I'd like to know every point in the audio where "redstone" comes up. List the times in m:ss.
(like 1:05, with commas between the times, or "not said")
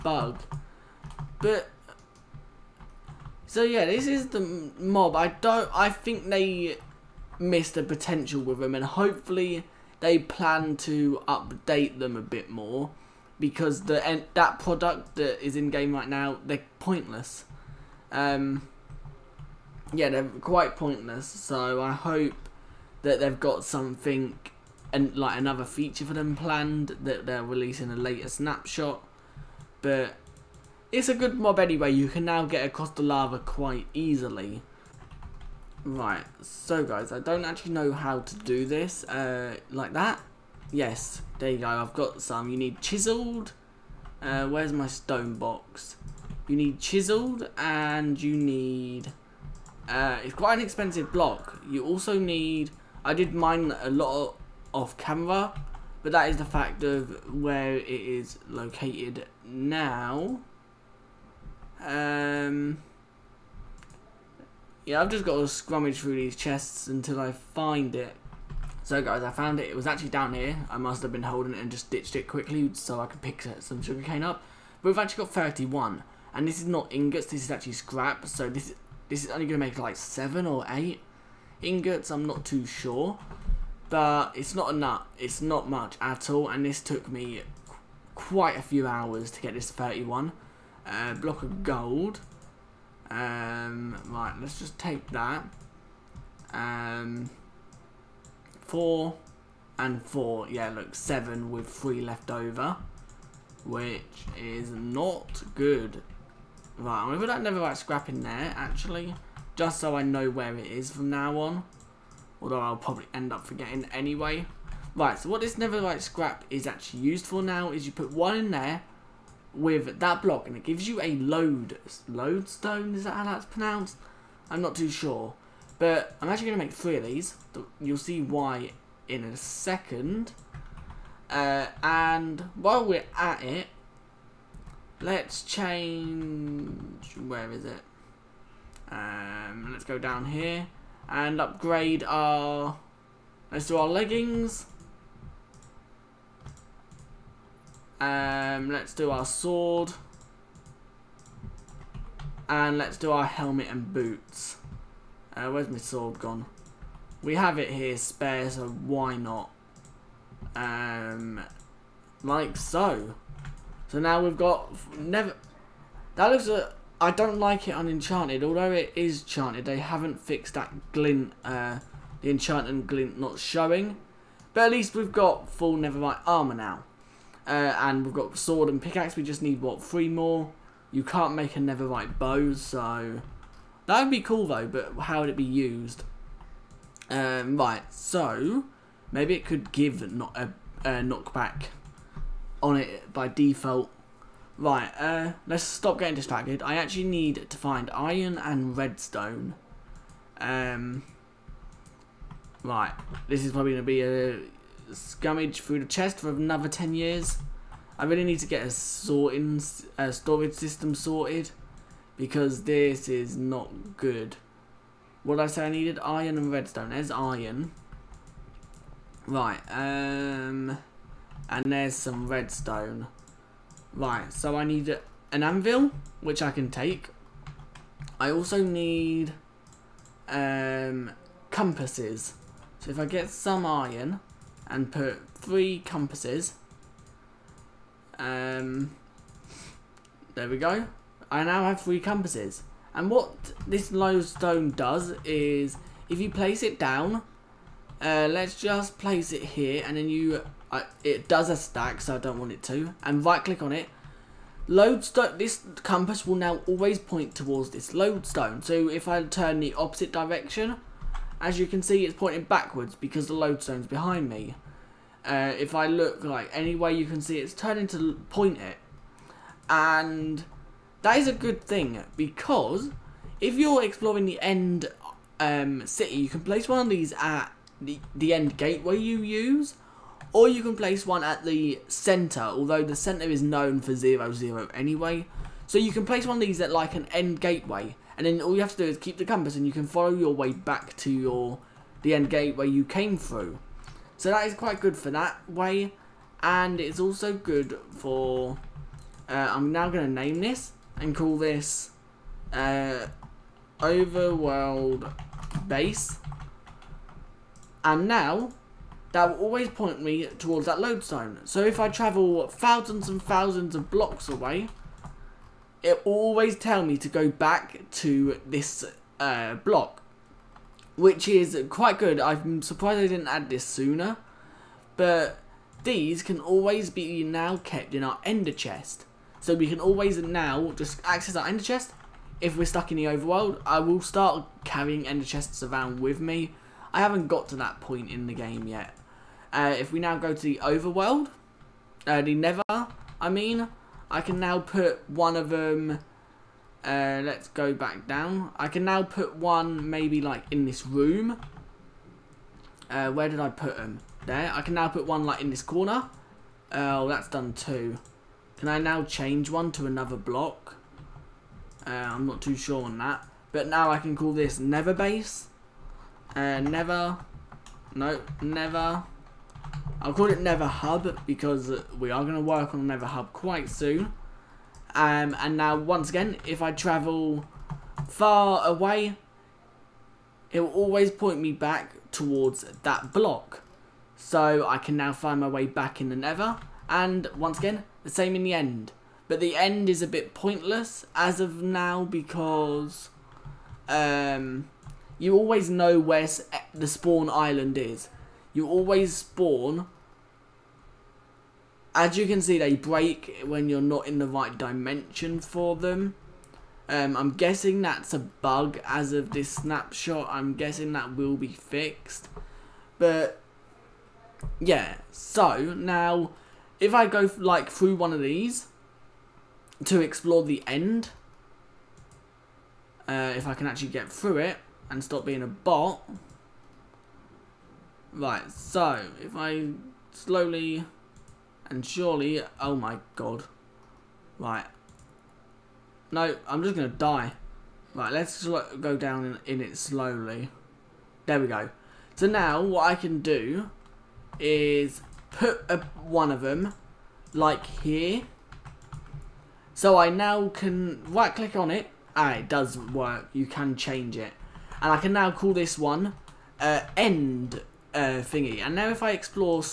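3:18, 3:36, 3:42.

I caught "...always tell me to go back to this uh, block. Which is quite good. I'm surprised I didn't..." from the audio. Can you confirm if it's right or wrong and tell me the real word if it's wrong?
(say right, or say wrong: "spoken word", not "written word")
right.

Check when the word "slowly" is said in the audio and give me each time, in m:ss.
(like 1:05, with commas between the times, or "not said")
7:10, 7:19.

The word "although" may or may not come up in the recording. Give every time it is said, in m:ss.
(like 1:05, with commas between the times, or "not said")
1:52, 2:48, 4:42.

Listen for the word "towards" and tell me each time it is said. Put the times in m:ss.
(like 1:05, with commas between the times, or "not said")
4:17, 5:10, 6:22.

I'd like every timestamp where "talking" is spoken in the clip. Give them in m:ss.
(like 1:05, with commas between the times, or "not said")
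not said.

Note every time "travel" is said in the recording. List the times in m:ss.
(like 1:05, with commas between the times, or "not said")
5:11, 6:16.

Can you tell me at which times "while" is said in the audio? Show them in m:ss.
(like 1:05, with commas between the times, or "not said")
2:12.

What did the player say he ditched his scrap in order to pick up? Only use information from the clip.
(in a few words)
Sugarcane.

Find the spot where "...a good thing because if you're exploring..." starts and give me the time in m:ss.
4:31.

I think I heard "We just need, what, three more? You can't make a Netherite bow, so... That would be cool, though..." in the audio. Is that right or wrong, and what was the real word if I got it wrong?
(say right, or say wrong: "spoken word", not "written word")
right.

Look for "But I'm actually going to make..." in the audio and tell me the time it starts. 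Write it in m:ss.
2:05.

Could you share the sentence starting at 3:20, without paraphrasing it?
Um, right, this is probably going to be a scummage through the chest for another 10 years.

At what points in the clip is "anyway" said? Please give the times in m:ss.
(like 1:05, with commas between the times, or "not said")
0:31, 1:53, 4:44.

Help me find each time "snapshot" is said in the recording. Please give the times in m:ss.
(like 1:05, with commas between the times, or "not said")
0:28, 6:49.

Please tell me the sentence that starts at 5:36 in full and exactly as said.
I haven't got to that point in the game yet.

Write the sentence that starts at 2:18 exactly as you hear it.
Um, let's go down here and upgrade our...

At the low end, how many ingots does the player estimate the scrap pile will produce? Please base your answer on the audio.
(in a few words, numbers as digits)
7.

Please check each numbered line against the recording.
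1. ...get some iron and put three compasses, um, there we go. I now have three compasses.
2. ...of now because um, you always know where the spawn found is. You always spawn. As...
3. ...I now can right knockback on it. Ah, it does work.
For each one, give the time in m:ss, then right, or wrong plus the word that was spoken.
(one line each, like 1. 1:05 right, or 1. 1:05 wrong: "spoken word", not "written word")
1. 3:53 right
2. 6:31 wrong: "island", not "found"
3. 7:29 wrong: "click", not "knockback".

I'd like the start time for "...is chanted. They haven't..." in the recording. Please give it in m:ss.
2:48.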